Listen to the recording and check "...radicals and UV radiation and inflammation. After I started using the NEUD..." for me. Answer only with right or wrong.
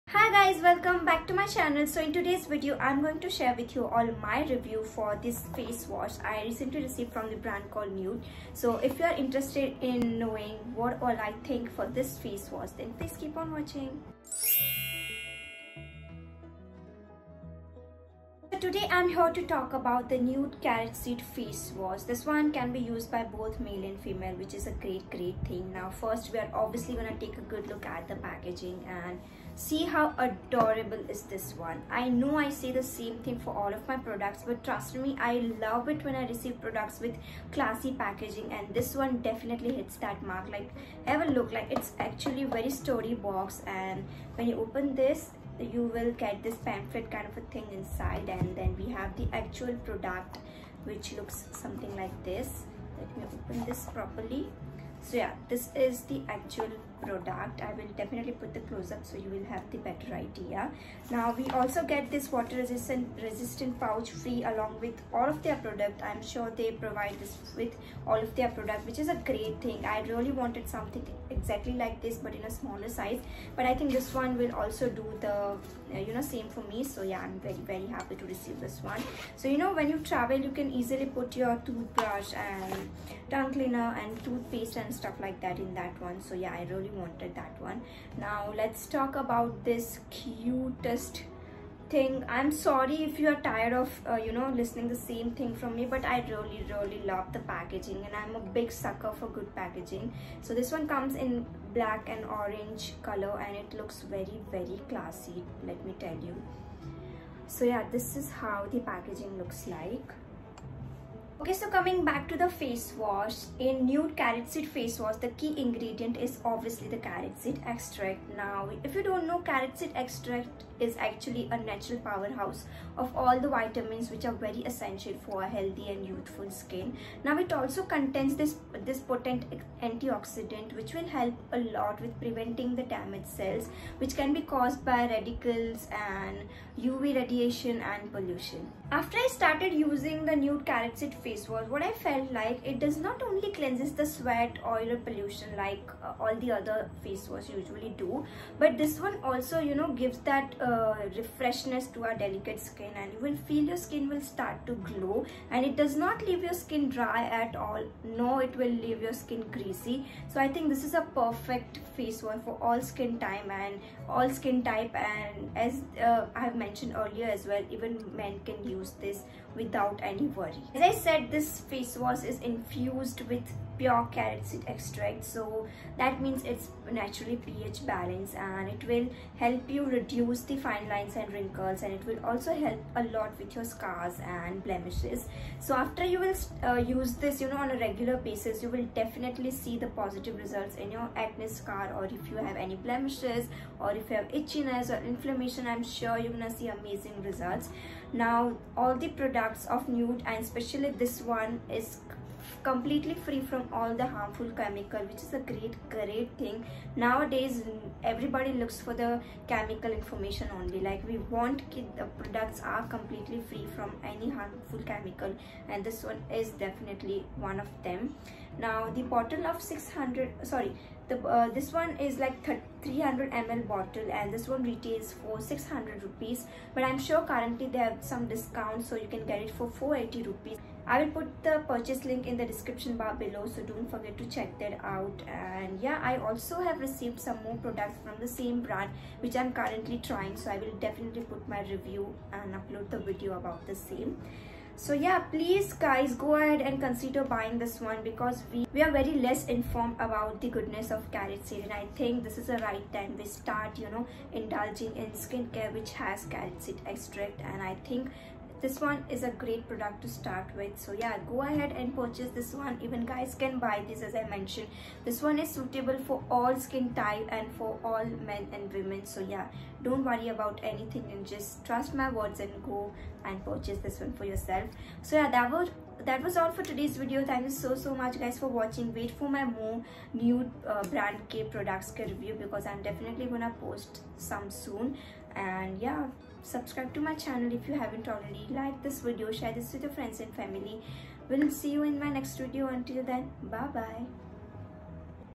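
wrong.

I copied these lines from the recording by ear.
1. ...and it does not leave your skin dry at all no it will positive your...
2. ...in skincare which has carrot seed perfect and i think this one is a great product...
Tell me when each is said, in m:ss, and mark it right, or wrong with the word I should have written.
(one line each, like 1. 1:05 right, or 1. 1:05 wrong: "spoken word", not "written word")
1. 2:35 wrong: "leave", not "positive"
2. 4:14 wrong: "extract", not "perfect".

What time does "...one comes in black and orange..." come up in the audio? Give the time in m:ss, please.
1:40.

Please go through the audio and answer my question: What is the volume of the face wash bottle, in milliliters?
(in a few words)
300 ml.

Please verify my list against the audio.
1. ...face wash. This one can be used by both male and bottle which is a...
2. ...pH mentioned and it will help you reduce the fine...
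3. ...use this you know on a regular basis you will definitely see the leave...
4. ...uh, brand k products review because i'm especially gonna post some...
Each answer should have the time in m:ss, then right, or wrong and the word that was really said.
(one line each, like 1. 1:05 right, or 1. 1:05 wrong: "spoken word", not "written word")
1. 0:21 wrong: "female", not "bottle"
2. 2:57 wrong: "balanced", not "mentioned"
3. 3:06 wrong: "positive", not "leave"
4. 4:40 wrong: "definitely", not "especially".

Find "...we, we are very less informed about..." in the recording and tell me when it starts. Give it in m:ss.
4:08.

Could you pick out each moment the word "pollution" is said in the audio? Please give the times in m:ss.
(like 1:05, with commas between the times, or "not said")
2:18, 2:24.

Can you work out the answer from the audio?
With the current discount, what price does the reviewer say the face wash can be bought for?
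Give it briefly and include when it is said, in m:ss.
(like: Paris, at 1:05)
480 rupees, at 3:49.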